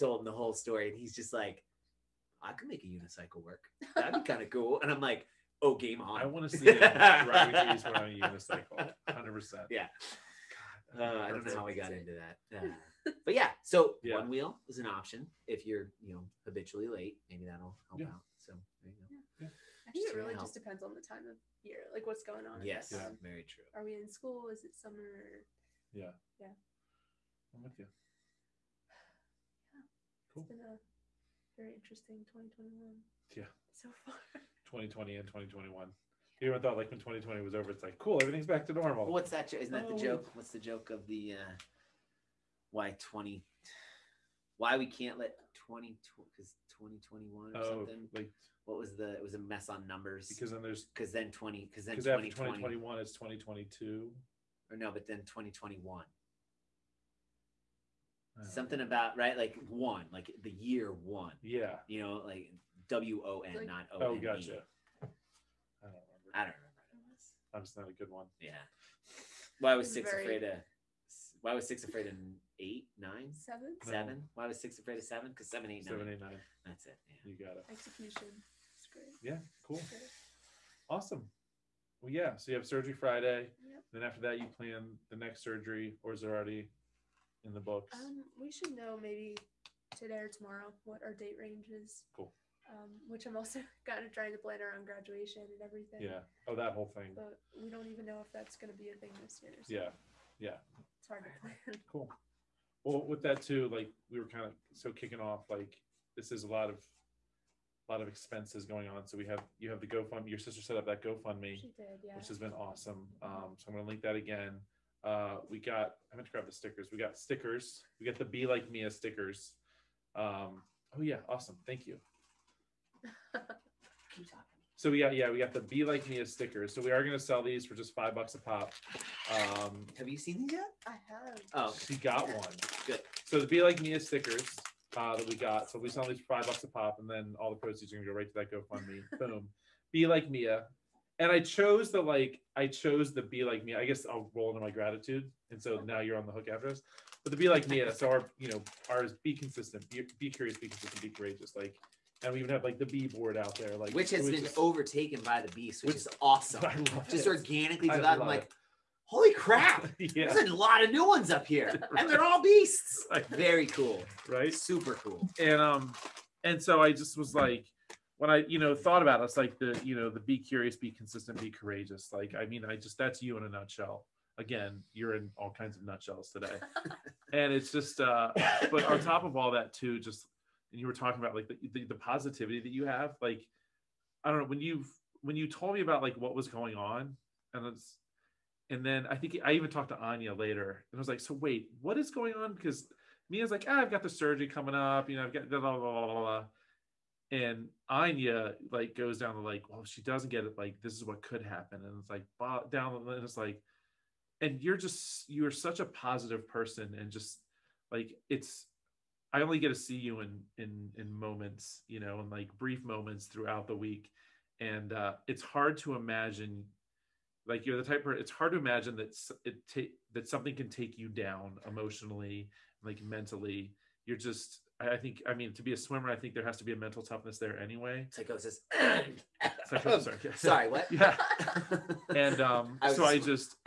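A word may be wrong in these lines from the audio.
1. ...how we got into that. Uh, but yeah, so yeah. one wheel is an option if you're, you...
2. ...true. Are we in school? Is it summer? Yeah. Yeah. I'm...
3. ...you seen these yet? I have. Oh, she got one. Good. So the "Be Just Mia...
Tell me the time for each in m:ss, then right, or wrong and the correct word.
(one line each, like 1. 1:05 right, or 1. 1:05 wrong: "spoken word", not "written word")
1. 0:11 right
2. 0:23 right
3. 2:10 wrong: "Like", not "Just".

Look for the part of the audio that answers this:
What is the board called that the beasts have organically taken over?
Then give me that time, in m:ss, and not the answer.
2:32.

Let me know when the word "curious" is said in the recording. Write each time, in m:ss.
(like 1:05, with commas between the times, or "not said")
2:30, 2:50.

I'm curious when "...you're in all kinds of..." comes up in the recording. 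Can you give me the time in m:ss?
2:54.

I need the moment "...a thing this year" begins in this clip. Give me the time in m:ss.
1:38.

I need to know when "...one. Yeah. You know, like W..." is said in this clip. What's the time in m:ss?
1:00.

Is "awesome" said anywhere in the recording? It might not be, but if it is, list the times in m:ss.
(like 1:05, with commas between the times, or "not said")
1:20, 1:52, 2:01, 2:36.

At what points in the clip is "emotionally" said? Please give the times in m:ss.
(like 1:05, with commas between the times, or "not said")
3:41.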